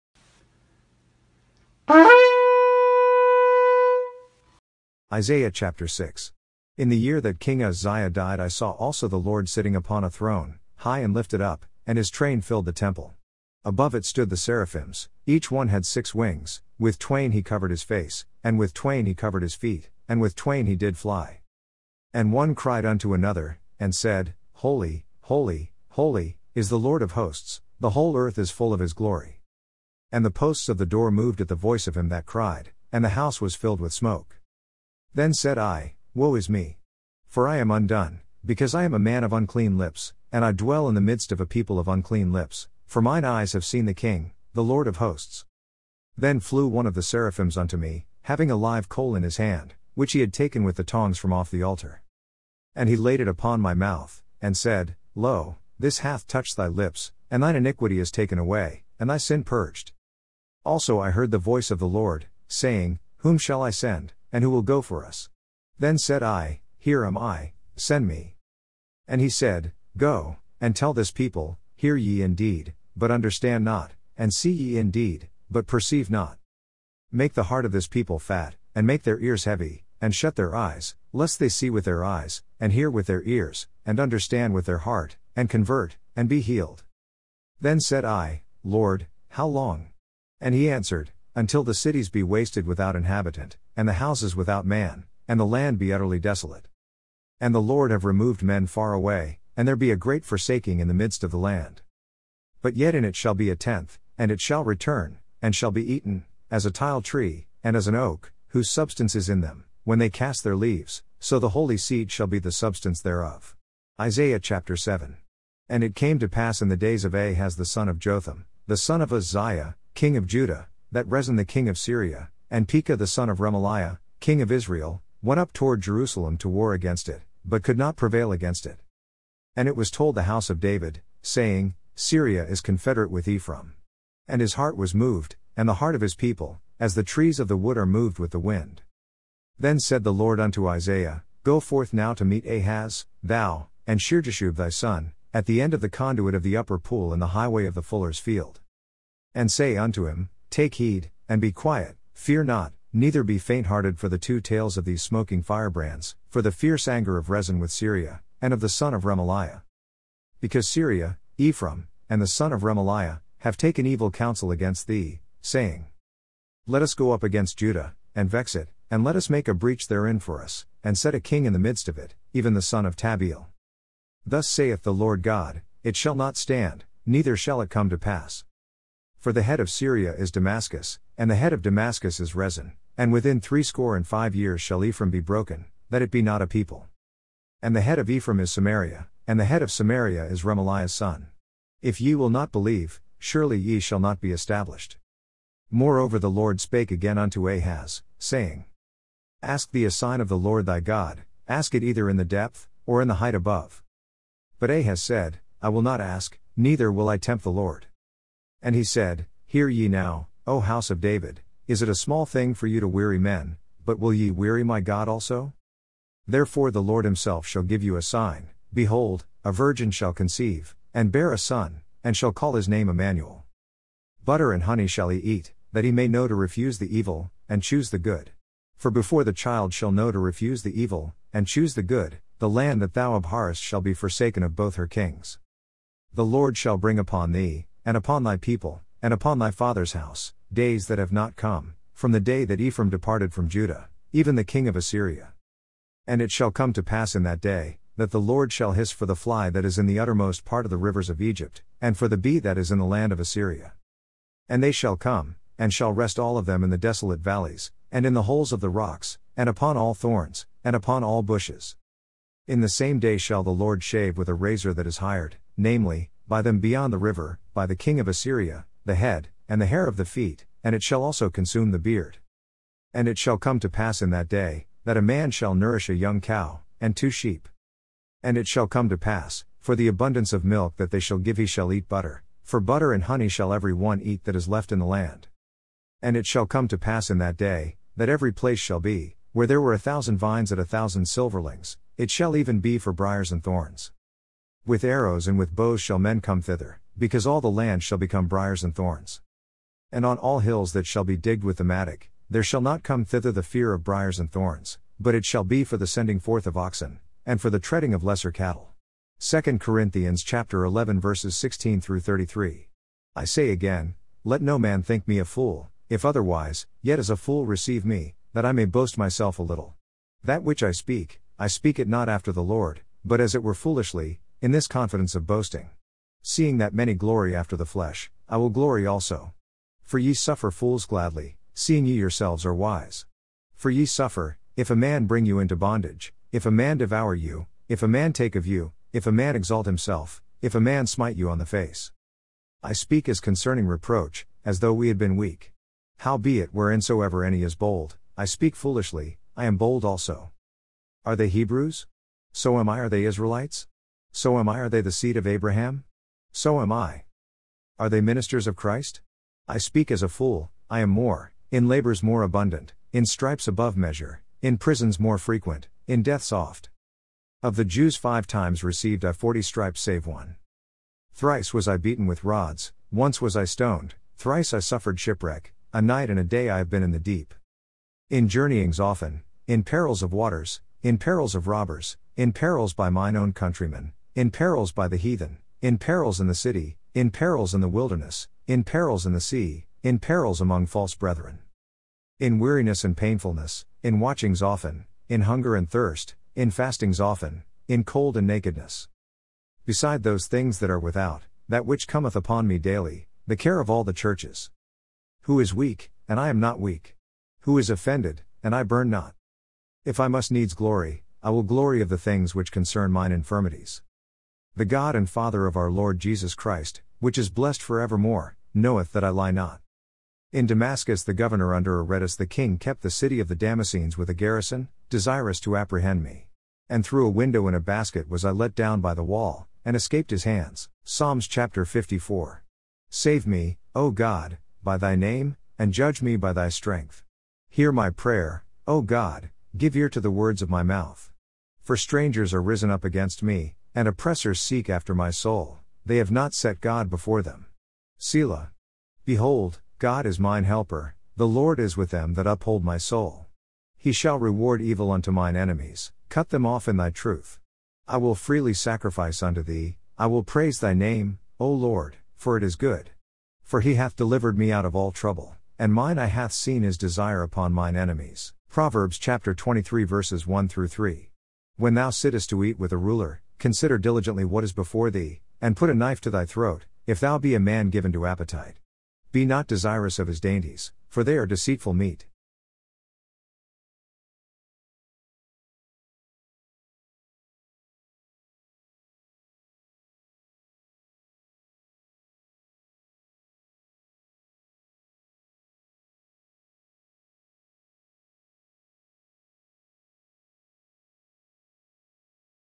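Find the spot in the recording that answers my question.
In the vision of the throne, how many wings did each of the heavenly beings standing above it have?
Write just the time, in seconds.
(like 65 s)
15 s.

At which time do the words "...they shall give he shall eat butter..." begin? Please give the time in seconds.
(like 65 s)
280 s.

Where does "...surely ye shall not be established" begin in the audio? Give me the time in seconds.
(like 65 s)
193 s.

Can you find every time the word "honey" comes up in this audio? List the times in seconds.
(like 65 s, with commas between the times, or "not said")
224 s, 283 s.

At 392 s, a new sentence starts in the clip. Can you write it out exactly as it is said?
In weariness and painfulness, in watchings often, in hunger and thirst, in fastings often, in cold and nakedness.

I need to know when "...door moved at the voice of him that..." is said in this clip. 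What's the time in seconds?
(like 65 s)
30 s.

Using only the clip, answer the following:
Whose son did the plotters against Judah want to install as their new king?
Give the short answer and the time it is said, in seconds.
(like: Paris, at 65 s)
Tabeal, at 172 s.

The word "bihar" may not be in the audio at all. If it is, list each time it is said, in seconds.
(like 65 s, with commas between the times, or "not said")
not said.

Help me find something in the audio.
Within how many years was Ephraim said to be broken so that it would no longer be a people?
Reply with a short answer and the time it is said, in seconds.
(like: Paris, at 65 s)
65, at 183 s.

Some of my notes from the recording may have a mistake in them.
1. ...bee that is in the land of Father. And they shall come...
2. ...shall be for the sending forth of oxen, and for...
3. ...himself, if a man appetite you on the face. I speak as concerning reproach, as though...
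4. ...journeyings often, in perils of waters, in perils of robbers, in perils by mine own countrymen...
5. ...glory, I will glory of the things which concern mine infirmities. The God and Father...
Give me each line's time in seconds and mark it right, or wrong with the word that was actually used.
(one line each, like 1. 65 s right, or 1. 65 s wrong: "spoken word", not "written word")
1. 252 s wrong: "Assyria", not "Father"
2. 305 s right
3. 339 s wrong: "smite", not "appetite"
4. 378 s right
5. 410 s right.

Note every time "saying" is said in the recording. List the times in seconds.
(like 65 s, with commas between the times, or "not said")
62 s, 131 s, 165 s, 198 s.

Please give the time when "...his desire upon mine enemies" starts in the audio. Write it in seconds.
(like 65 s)
466 s.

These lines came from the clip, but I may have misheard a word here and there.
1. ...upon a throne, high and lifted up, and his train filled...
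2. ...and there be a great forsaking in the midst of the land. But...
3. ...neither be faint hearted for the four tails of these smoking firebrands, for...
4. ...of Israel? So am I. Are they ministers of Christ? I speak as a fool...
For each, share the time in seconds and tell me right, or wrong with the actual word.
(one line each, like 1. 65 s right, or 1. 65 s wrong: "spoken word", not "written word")
1. 9 s right
2. 99 s right
3. 152 s wrong: "two", not "four"
4. 355 s wrong: "Abraham", not "Israel".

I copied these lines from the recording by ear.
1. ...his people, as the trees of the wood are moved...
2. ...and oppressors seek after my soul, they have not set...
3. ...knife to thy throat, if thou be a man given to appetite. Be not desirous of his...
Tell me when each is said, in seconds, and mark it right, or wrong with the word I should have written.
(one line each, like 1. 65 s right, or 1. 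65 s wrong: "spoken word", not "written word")
1. 136 s right
2. 443 s right
3. 475 s right.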